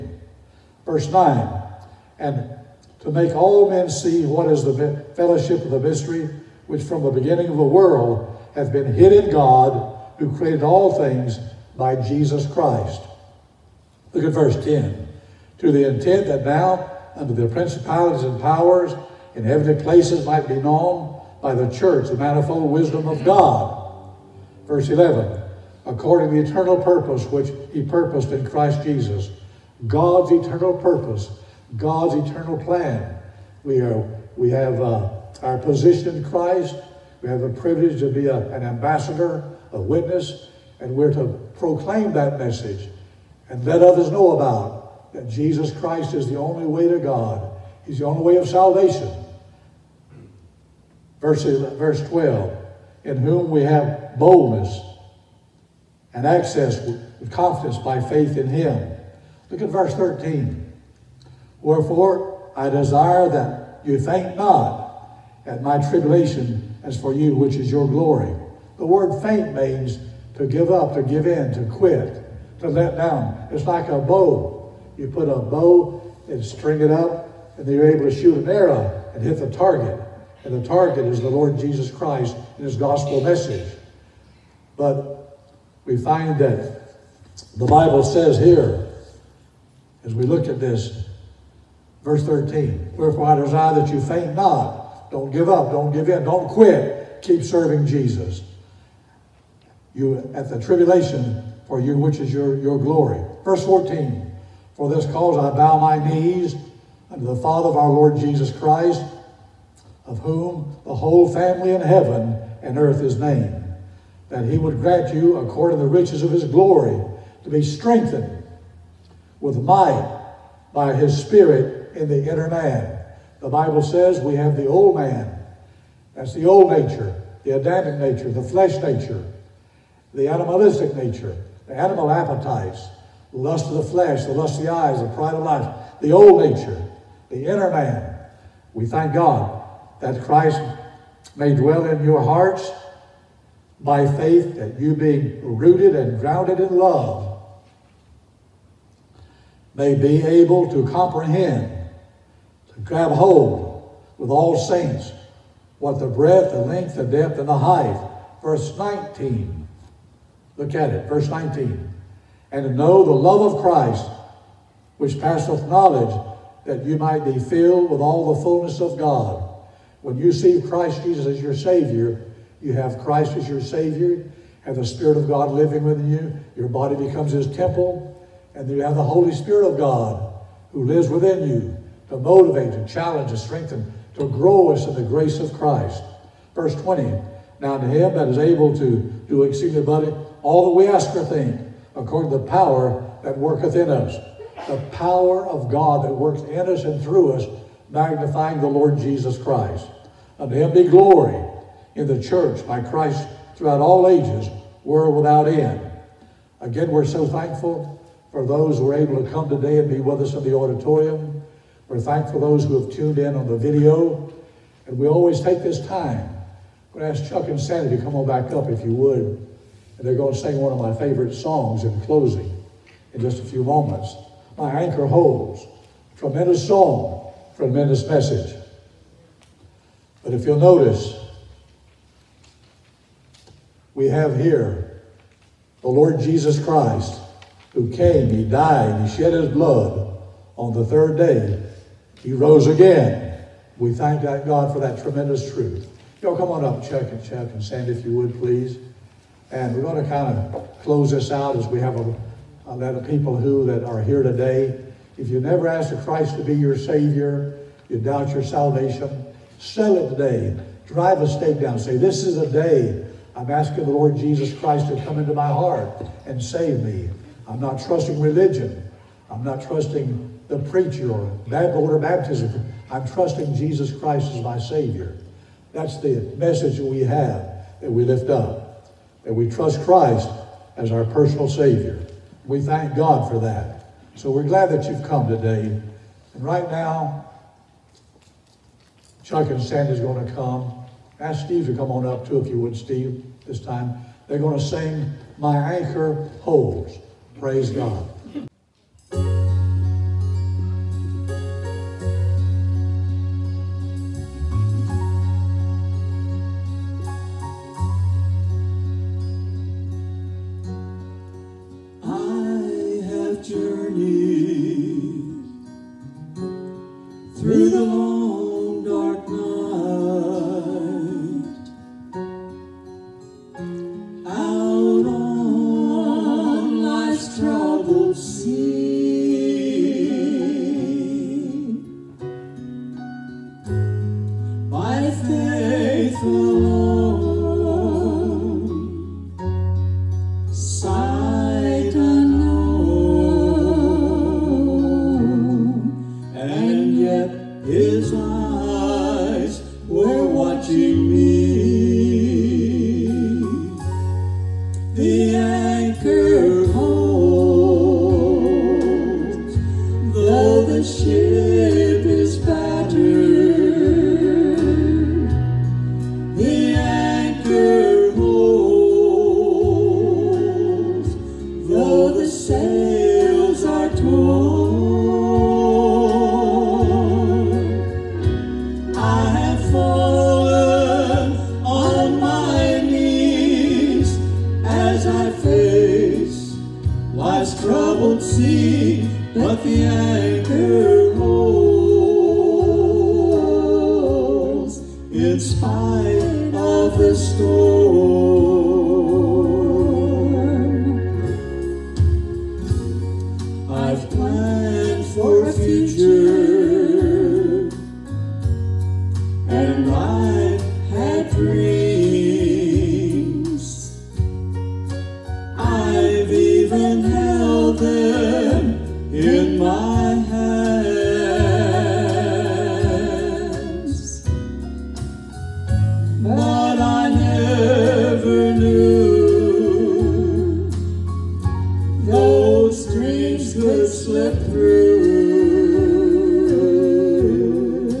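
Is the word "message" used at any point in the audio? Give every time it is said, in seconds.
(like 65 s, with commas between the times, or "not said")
42 s, 83 s, 228 s, 276 s.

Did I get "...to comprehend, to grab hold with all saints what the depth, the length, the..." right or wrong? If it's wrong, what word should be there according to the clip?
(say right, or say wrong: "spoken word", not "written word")
wrong: "breadth", not "depth".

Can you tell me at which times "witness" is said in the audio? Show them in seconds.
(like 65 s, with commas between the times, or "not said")
39 s.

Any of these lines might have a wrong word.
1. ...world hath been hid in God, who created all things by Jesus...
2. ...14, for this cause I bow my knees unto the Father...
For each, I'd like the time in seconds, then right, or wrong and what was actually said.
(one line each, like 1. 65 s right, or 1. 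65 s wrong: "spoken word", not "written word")
1. 7 s right
2. 103 s right.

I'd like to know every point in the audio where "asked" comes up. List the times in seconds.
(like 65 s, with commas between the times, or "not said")
255 s.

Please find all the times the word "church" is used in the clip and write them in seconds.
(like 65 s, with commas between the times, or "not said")
21 s, 202 s.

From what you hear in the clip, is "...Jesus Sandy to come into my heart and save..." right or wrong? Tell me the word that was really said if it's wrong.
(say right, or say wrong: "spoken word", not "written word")
wrong: "Christ", not "Sandy".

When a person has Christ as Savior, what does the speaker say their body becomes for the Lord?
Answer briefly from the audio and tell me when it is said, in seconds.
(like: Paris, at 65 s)
His temple, at 177 s.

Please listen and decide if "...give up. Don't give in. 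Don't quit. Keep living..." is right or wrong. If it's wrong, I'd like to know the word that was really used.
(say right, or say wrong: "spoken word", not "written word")
wrong: "serving", not "living".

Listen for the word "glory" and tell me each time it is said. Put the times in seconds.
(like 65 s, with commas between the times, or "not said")
67 s, 102 s, 116 s, 200 s.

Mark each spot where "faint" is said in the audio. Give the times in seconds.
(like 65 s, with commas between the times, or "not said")
63 s, 69 s, 93 s.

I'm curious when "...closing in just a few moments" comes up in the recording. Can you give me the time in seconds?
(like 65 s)
222 s.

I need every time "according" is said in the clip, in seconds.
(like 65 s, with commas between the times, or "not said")
25 s, 115 s, 191 s.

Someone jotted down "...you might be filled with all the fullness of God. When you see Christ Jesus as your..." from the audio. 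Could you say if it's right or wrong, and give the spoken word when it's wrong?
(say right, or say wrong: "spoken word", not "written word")
right.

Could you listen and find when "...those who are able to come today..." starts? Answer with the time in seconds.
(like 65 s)
208 s.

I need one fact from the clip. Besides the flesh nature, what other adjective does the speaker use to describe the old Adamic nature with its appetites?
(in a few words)
animalistic.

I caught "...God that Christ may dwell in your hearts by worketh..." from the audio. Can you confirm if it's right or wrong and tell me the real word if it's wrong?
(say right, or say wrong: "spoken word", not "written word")
wrong: "faith", not "worketh".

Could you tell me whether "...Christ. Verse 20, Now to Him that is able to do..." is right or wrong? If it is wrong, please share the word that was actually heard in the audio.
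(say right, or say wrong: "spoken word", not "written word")
right.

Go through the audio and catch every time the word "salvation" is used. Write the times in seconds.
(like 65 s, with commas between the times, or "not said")
48 s, 258 s.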